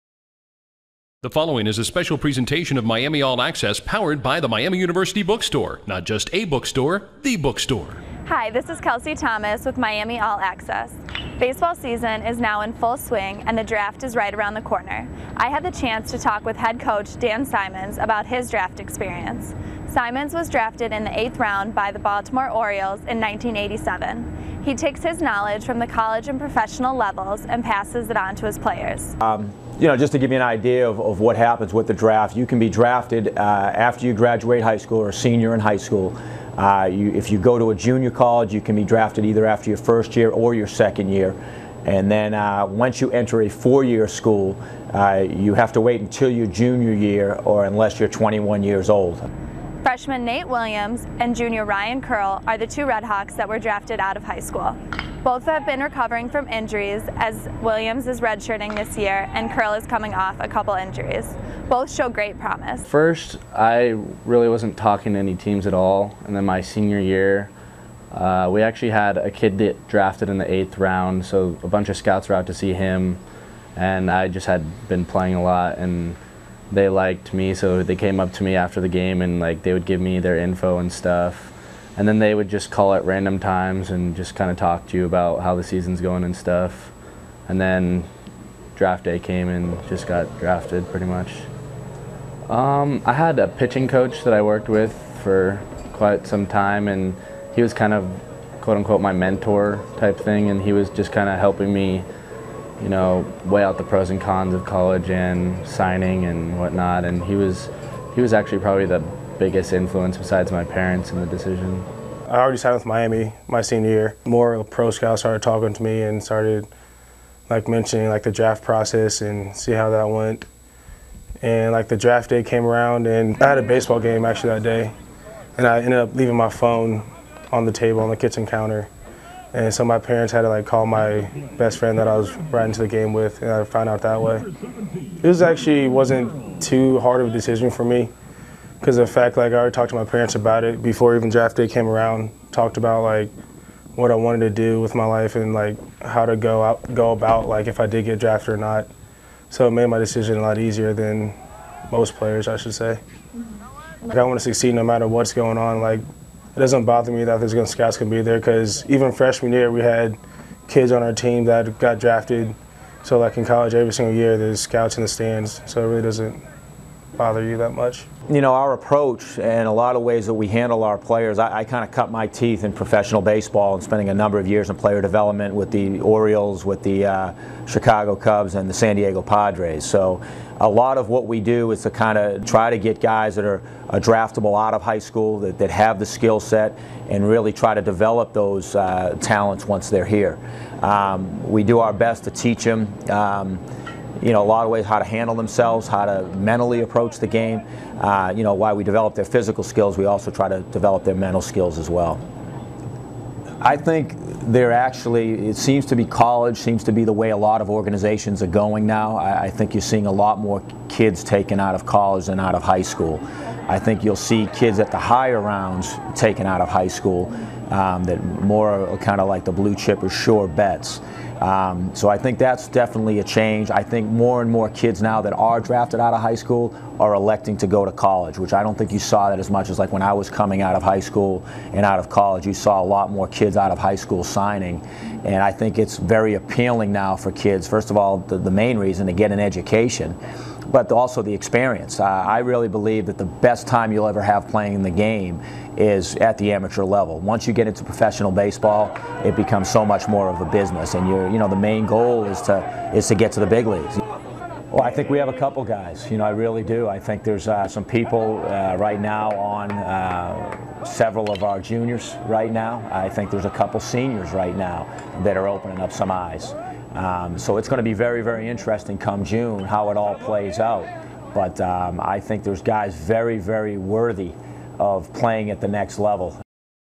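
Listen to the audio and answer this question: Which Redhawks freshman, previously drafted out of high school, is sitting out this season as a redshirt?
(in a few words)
Nate Williams.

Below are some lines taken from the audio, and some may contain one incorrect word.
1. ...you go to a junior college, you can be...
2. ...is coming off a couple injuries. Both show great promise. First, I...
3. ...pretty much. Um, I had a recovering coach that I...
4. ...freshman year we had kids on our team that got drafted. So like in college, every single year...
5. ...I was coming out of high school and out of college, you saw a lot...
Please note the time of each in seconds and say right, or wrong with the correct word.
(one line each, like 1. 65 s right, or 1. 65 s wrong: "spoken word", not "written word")
1. 37 s right
2. 59 s right
3. 90 s wrong: "pitching", not "recovering"
4. 159 s right
5. 230 s right.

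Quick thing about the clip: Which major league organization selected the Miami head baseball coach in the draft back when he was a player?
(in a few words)
Baltimore Orioles.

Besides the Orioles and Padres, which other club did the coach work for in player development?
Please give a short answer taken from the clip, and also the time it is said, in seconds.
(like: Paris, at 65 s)
Chicago Cubs, at 177 s.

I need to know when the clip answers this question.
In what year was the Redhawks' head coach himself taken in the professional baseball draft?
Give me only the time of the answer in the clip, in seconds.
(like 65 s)
23 s.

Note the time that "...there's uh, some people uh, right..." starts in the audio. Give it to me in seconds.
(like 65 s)
257 s.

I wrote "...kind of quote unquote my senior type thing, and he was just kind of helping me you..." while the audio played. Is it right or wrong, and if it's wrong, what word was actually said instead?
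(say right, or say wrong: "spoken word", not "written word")
wrong: "mentor", not "senior".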